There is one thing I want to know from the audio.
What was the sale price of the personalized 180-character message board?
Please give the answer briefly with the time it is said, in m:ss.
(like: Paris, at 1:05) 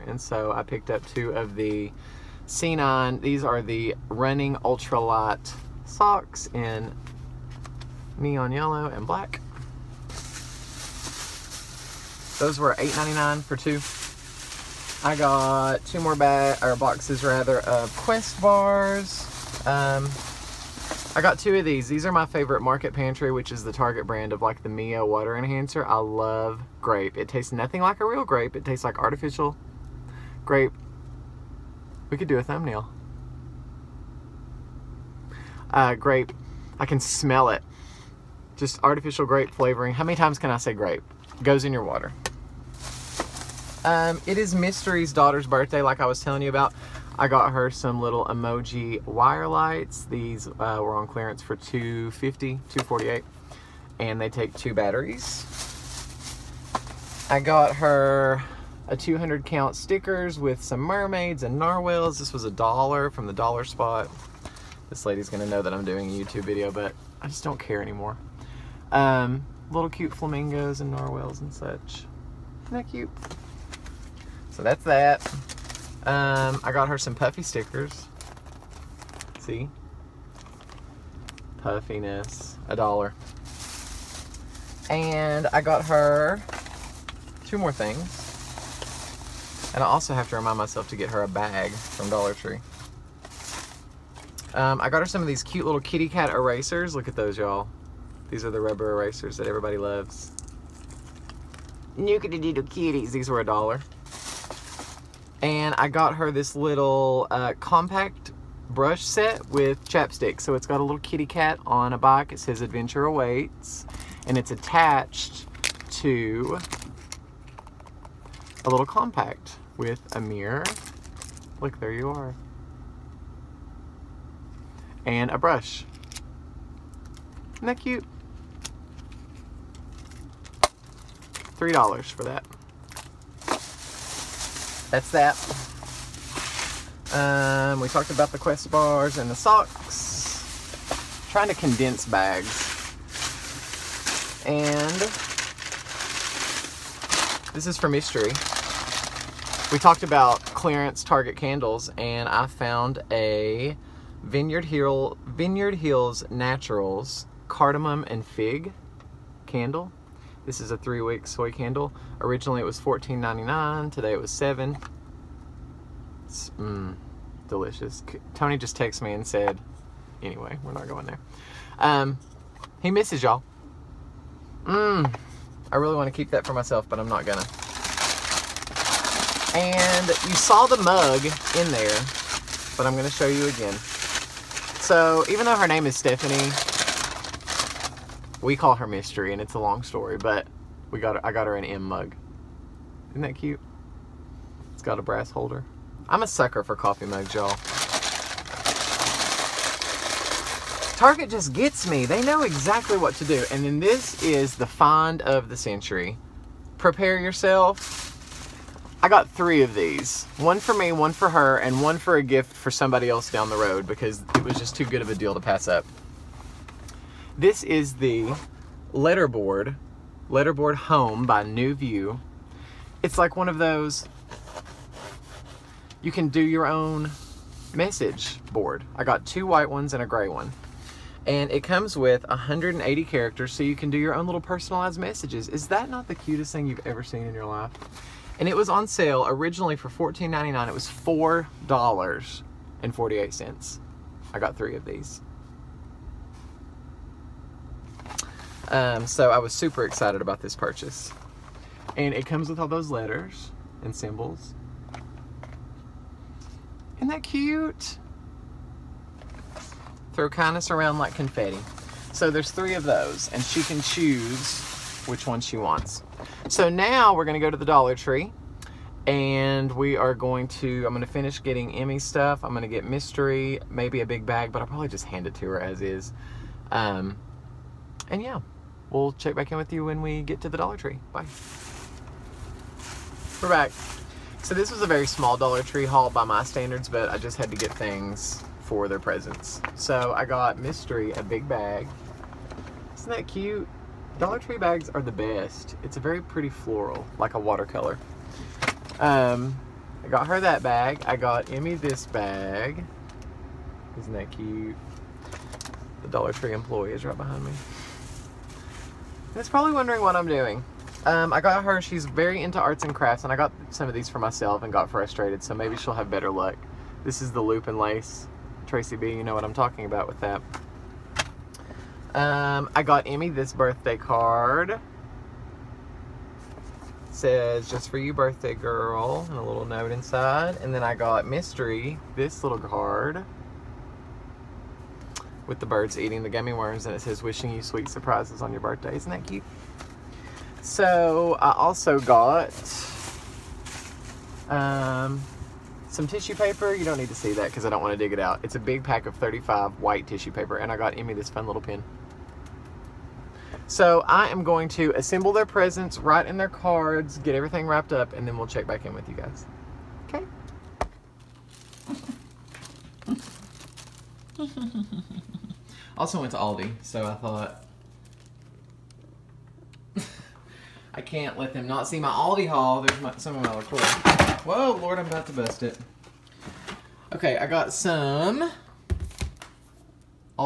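$4.48, at 4:00.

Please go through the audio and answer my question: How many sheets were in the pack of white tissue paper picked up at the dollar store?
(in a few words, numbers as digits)
35.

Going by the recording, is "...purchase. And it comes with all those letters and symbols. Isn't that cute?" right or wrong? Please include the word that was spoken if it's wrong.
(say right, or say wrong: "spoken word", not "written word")
right.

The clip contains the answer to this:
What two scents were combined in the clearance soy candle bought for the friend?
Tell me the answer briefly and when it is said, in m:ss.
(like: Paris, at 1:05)
cardamom and fig, at 2:37.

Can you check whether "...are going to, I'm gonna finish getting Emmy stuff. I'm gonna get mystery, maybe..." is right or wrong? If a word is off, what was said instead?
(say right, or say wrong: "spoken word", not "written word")
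right.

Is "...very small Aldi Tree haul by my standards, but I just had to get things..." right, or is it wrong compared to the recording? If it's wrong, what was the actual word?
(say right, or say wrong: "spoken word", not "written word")
wrong: "Dollar", not "Aldi".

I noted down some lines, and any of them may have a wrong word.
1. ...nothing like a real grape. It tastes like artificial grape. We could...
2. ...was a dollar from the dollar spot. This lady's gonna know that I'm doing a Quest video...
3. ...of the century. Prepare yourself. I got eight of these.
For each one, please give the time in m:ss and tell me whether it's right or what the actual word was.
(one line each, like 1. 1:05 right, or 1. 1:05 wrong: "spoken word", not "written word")
1. 0:27 right
2. 1:02 wrong: "YouTube", not "Quest"
3. 3:25 wrong: "three", not "eight".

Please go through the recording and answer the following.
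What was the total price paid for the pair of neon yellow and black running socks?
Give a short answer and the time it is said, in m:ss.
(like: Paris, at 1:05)
$8.99, at 0:12.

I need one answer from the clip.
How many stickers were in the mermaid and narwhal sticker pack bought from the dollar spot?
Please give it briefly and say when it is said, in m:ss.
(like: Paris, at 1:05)
200, at 0:58.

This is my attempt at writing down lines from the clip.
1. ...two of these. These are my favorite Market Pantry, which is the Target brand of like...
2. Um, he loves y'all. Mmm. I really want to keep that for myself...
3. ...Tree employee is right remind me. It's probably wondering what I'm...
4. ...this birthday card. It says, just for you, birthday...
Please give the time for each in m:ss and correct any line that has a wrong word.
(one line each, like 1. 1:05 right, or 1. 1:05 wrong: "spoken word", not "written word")
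1. 0:21 right
2. 2:51 wrong: "misses", not "loves"
3. 5:06 wrong: "behind", not "remind"
4. 5:23 right.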